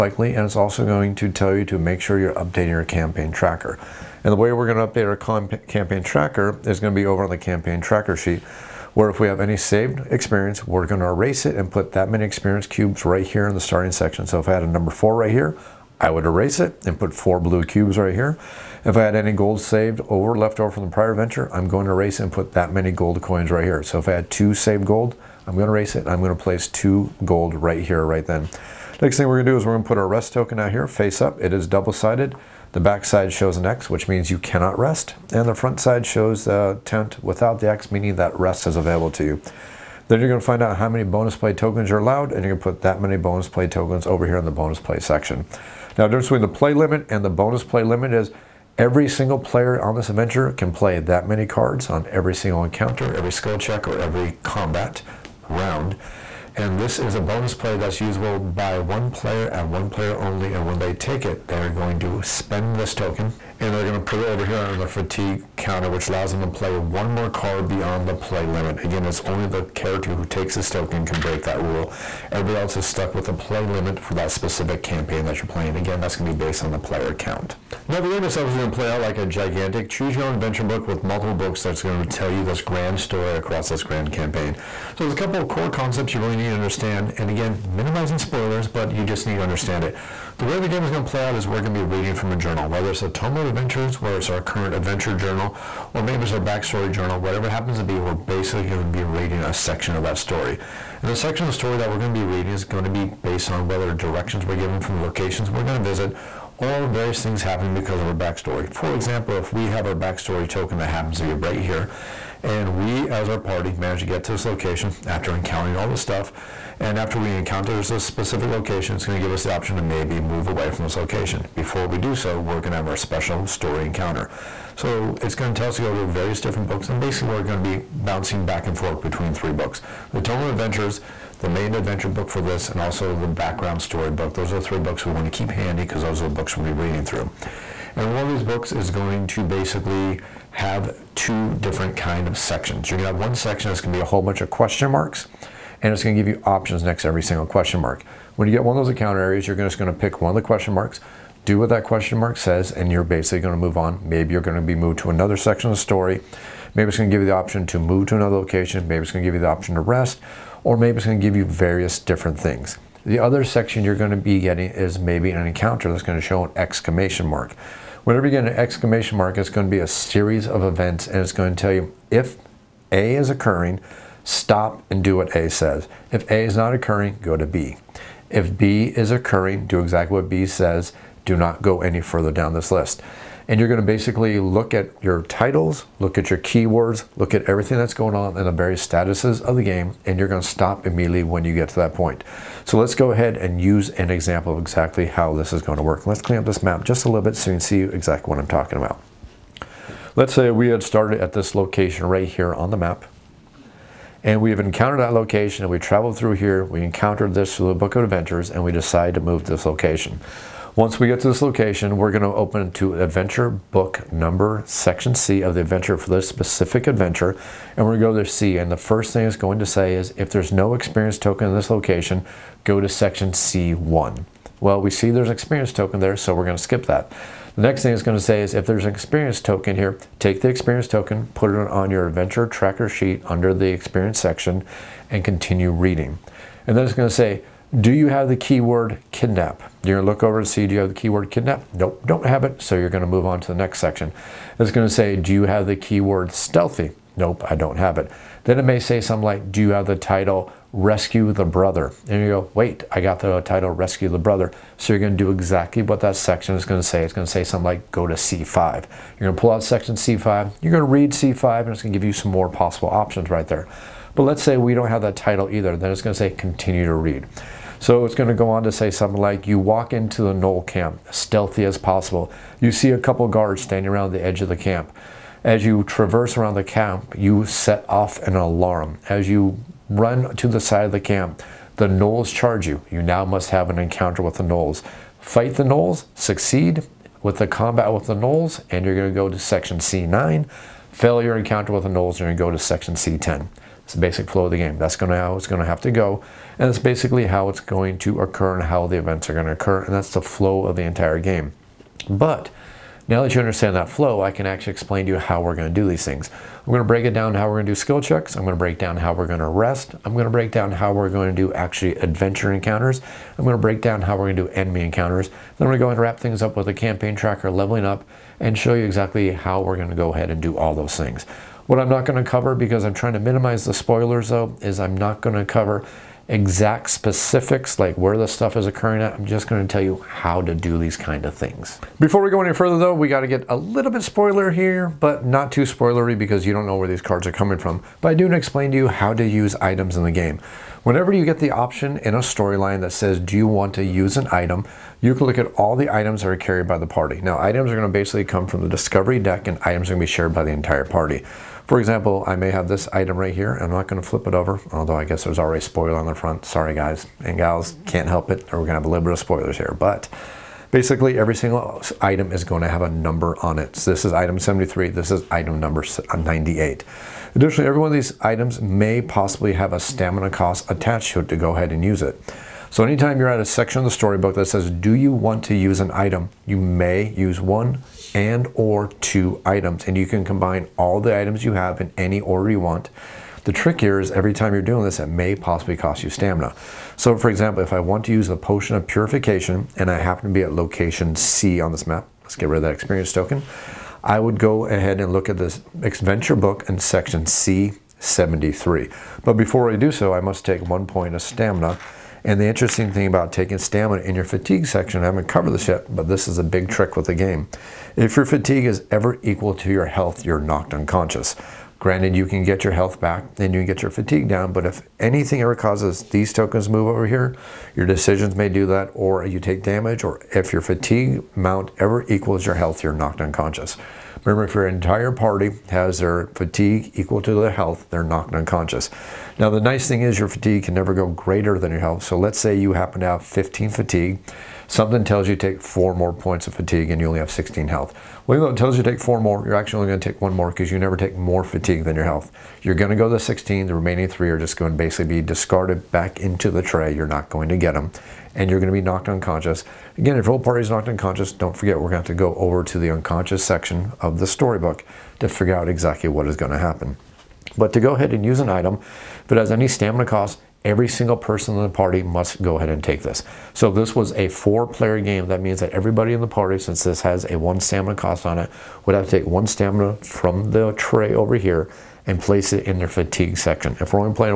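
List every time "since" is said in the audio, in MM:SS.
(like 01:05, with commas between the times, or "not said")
07:46.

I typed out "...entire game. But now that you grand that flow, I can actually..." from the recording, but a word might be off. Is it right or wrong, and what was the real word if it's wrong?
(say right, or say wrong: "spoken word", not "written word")
wrong: "understand", not "grand".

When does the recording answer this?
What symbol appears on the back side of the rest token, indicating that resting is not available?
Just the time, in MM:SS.
00:33.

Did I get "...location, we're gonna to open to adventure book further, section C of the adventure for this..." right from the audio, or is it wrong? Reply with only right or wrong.
wrong.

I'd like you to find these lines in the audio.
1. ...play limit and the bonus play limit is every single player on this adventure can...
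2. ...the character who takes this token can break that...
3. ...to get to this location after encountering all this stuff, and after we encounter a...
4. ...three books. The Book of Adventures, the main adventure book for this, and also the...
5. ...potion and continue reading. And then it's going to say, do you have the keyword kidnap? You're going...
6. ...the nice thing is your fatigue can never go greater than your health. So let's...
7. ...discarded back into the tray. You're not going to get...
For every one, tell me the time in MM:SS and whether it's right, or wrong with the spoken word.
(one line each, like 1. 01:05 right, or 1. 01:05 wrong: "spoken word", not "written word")
1. 00:46 right
2. 01:09 right
3. 01:53 right
4. 02:09 wrong: "Tome", not "Book"
5. 03:54 wrong: "section", not "potion"
6. 07:09 right
7. 07:25 right.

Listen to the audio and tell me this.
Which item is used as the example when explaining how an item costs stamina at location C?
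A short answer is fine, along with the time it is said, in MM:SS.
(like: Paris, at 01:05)
Potion of purification, at 06:28.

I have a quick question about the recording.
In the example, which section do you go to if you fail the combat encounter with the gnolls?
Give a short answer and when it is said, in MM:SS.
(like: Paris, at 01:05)
C10, at 04:52.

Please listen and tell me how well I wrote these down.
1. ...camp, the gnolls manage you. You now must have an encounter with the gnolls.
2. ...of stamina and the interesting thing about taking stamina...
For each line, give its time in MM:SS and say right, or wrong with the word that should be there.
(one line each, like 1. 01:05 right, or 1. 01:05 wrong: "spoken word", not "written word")
1. 04:40 wrong: "charge", not "manage"
2. 06:41 right.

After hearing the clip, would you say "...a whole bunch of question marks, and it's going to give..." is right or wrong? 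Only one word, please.
right.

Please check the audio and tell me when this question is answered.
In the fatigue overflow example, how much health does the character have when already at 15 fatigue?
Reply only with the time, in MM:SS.
07:17.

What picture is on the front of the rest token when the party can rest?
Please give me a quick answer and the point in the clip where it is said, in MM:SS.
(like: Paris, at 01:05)
Tent, at 00:36.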